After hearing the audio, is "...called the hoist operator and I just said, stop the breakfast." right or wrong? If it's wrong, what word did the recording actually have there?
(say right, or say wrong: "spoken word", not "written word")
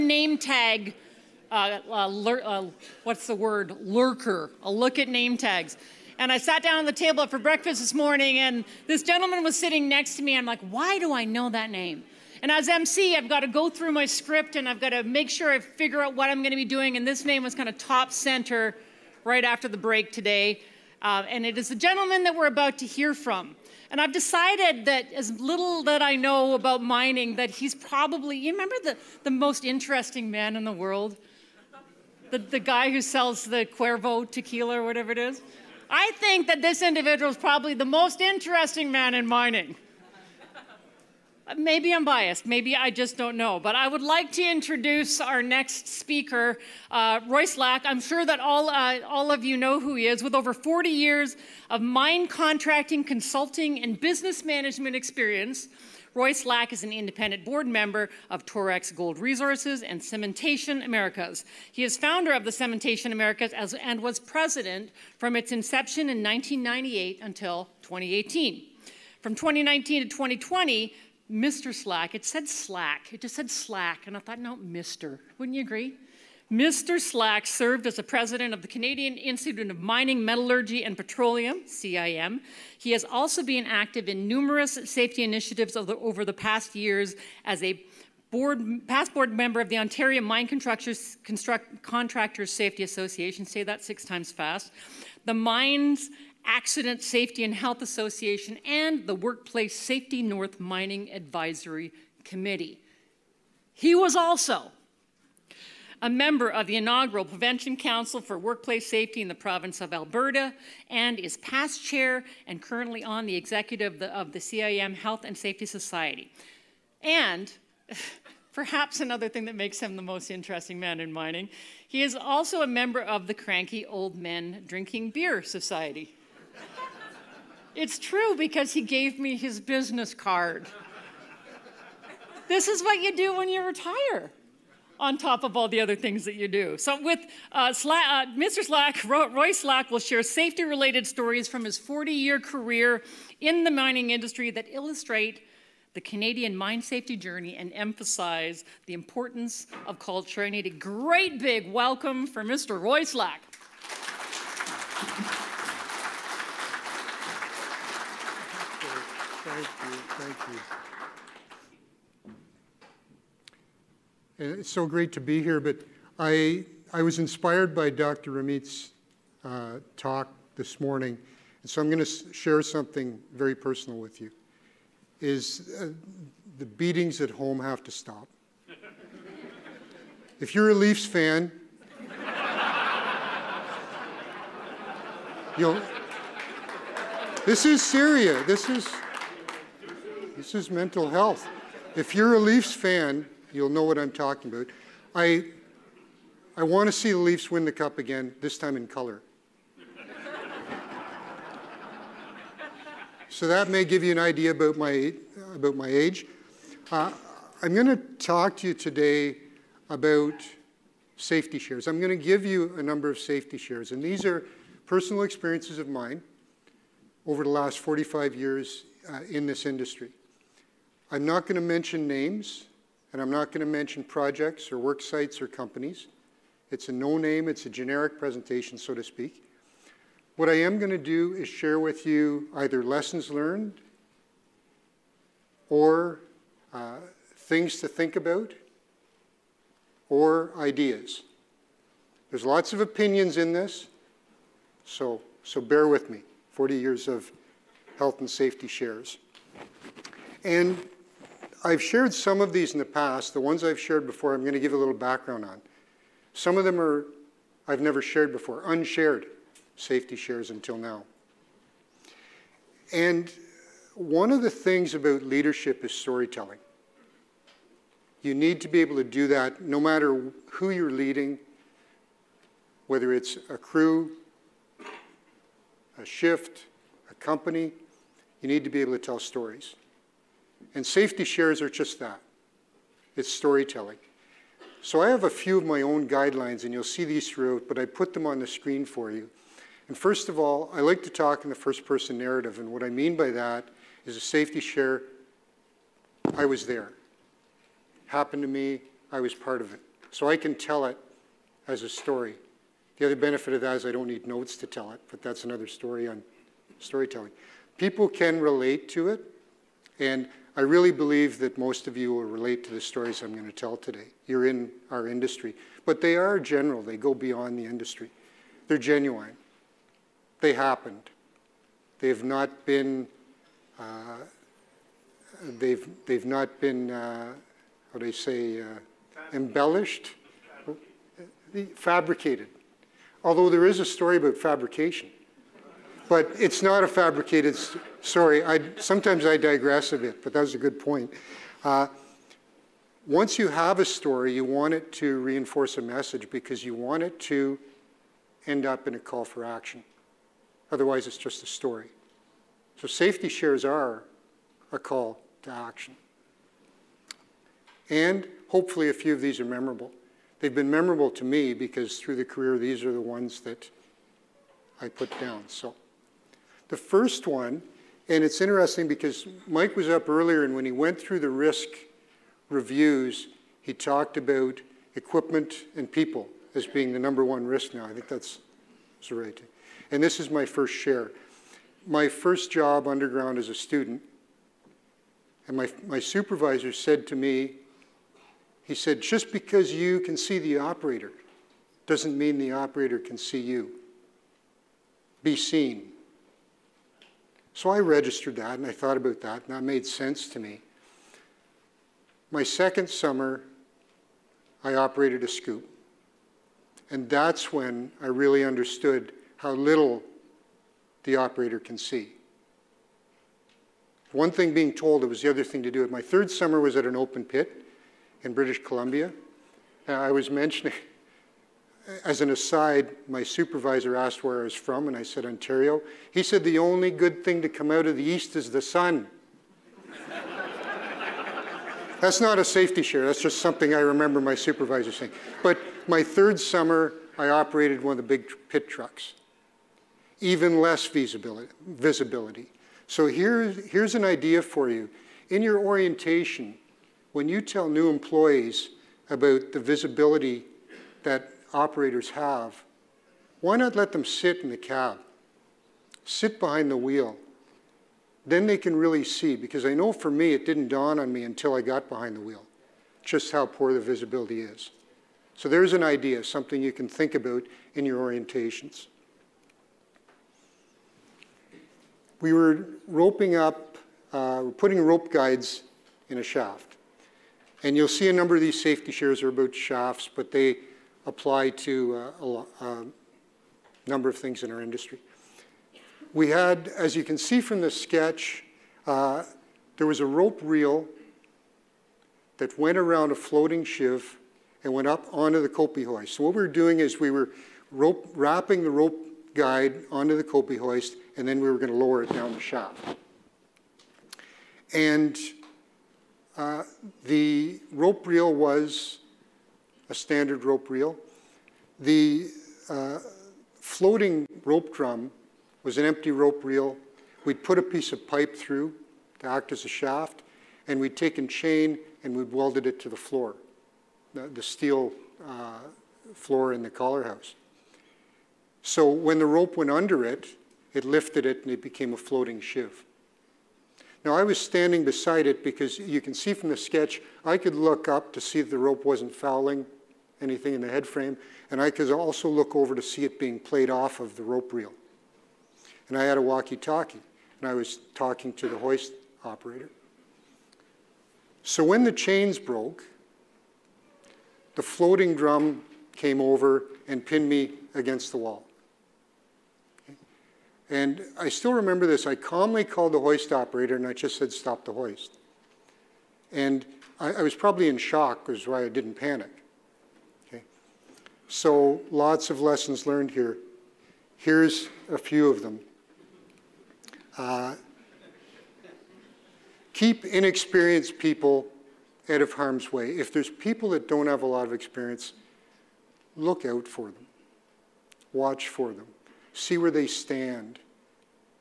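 wrong: "hoist", not "breakfast".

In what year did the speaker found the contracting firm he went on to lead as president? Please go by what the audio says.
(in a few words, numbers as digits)
1998.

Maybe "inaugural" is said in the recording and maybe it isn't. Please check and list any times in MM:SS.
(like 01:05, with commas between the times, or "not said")
01:46.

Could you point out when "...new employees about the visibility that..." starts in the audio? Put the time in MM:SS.
07:27.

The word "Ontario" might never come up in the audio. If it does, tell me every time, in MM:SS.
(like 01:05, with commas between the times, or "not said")
01:29, 07:05.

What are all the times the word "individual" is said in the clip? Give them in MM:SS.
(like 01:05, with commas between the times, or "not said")
00:36.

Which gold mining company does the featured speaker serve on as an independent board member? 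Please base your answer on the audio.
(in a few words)
Torex Gold Resources.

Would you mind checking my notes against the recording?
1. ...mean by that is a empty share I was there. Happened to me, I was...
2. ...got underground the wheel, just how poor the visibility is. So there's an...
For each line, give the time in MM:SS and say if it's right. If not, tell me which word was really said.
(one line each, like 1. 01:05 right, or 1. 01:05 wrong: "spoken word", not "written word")
1. 04:52 wrong: "safety", not "empty"
2. 07:41 wrong: "behind", not "underground".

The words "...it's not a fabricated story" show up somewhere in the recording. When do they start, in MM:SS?
05:36.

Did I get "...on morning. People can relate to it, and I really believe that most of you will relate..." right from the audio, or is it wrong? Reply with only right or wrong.
wrong.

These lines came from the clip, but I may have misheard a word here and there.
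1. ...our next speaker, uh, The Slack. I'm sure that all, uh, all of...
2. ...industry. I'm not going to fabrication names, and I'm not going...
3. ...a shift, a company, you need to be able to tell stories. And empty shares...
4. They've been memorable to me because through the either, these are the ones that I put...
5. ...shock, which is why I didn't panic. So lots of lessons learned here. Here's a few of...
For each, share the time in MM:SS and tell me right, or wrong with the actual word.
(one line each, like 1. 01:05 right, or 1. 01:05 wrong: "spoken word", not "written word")
1. 00:45 wrong: "Roy", not "The"
2. 03:39 wrong: "mention", not "fabrication"
3. 04:35 wrong: "safety", not "empty"
4. 06:00 wrong: "career", not "either"
5. 09:27 right.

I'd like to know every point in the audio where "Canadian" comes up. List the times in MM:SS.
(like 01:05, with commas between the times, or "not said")
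01:18, 02:26.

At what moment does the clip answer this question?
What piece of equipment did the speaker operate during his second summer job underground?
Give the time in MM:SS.
06:45.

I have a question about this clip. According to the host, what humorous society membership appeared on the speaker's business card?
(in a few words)
Cranky Old Men Drinking Beer Society.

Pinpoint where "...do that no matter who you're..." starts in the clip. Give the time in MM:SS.
04:29.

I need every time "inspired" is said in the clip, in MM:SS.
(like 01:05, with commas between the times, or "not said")
02:47.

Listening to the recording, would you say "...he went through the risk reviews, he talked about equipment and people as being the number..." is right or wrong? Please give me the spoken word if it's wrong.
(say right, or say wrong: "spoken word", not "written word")
right.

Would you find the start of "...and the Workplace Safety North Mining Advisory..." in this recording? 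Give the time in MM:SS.
01:38.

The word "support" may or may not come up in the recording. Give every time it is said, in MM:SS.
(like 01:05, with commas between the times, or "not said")
not said.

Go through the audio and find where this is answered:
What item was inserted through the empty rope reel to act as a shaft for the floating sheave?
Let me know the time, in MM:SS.
08:38.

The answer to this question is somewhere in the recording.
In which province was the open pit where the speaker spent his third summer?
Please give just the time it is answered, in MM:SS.
06:58.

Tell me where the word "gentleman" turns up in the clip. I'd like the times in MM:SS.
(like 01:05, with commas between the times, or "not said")
00:09, 00:21.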